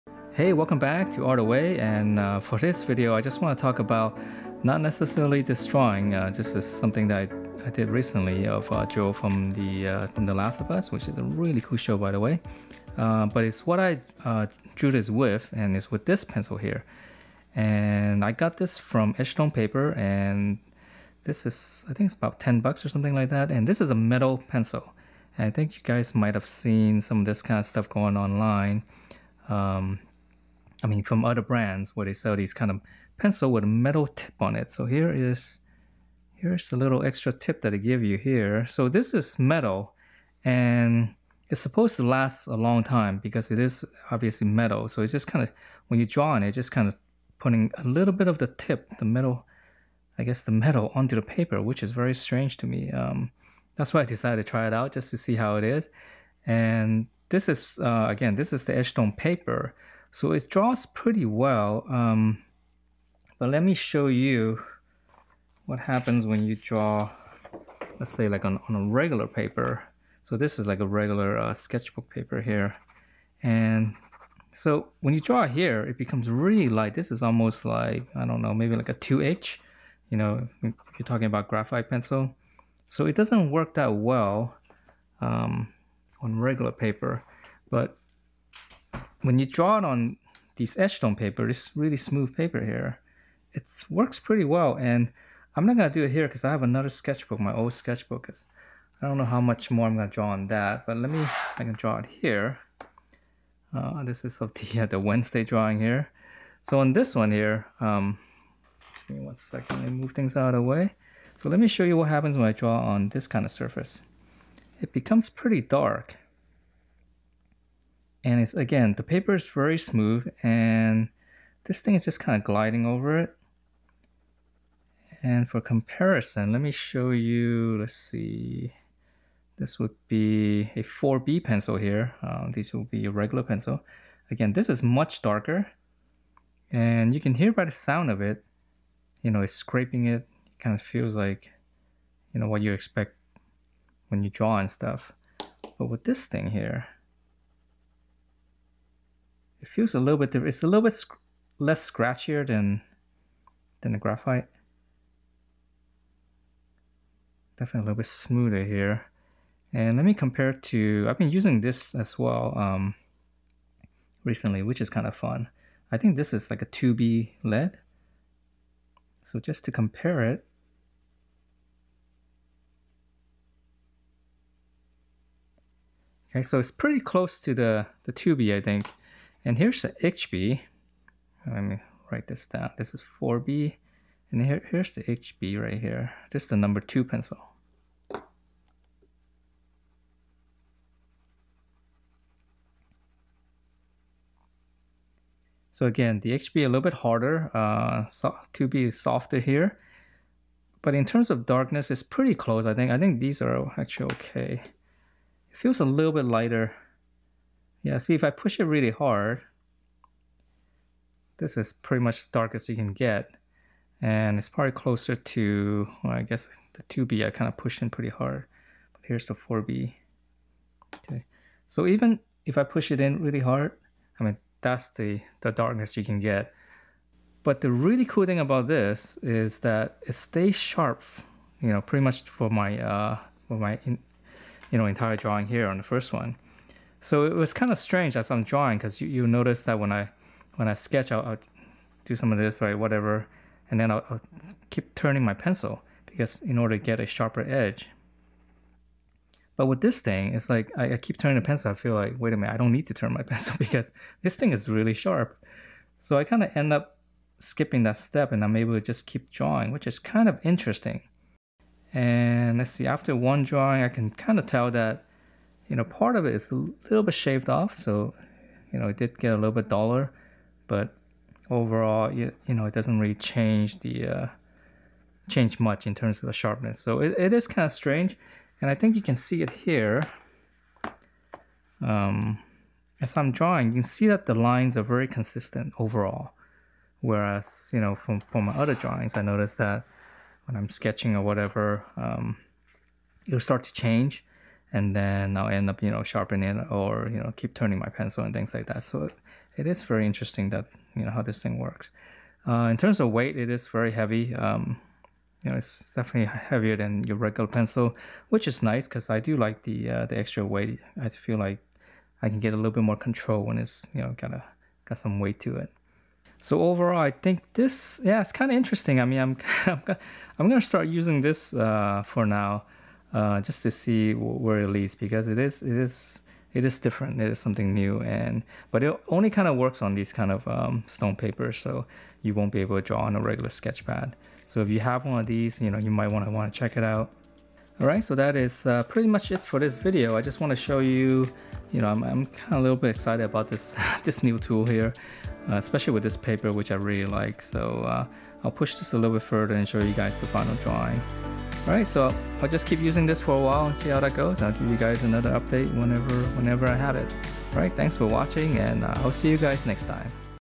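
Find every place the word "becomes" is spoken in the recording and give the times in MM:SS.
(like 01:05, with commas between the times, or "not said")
01:15, 01:54.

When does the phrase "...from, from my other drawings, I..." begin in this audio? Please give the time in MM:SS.
04:47.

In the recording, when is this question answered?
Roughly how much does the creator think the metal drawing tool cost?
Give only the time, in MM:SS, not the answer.
00:22.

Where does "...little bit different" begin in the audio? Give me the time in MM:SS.
02:29.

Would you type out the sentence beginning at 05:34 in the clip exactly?
So if you have one of these, you know you might want to want to check it out.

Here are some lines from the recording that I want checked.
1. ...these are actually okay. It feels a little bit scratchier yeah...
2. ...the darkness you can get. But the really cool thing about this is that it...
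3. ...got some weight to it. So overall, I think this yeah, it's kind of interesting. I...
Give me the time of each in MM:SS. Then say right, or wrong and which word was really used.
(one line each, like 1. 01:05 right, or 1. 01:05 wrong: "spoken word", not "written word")
1. 03:23 wrong: "lighter", not "scratchier"
2. 03:45 right
3. 05:14 right.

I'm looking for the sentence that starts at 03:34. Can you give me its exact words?
And it's probably closer to, well, I guess the 2B I kind of pushed in pretty hard.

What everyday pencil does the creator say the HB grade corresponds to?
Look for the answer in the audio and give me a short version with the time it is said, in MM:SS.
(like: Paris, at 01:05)
number two pencil, at 03:06.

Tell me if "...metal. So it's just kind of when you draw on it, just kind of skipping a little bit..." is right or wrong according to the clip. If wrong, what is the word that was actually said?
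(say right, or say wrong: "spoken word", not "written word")
wrong: "putting", not "skipping".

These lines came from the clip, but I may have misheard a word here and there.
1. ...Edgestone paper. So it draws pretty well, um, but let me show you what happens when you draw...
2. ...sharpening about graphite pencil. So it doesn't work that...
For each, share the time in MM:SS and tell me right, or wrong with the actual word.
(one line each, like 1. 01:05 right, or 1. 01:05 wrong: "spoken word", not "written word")
1. 00:58 right
2. 01:21 wrong: "talking", not "sharpening".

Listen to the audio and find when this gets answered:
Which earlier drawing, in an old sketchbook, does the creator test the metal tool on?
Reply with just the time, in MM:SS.
01:44.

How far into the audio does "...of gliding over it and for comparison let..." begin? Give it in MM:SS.
02:02.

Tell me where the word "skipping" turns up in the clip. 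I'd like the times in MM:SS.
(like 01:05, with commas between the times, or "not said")
04:17.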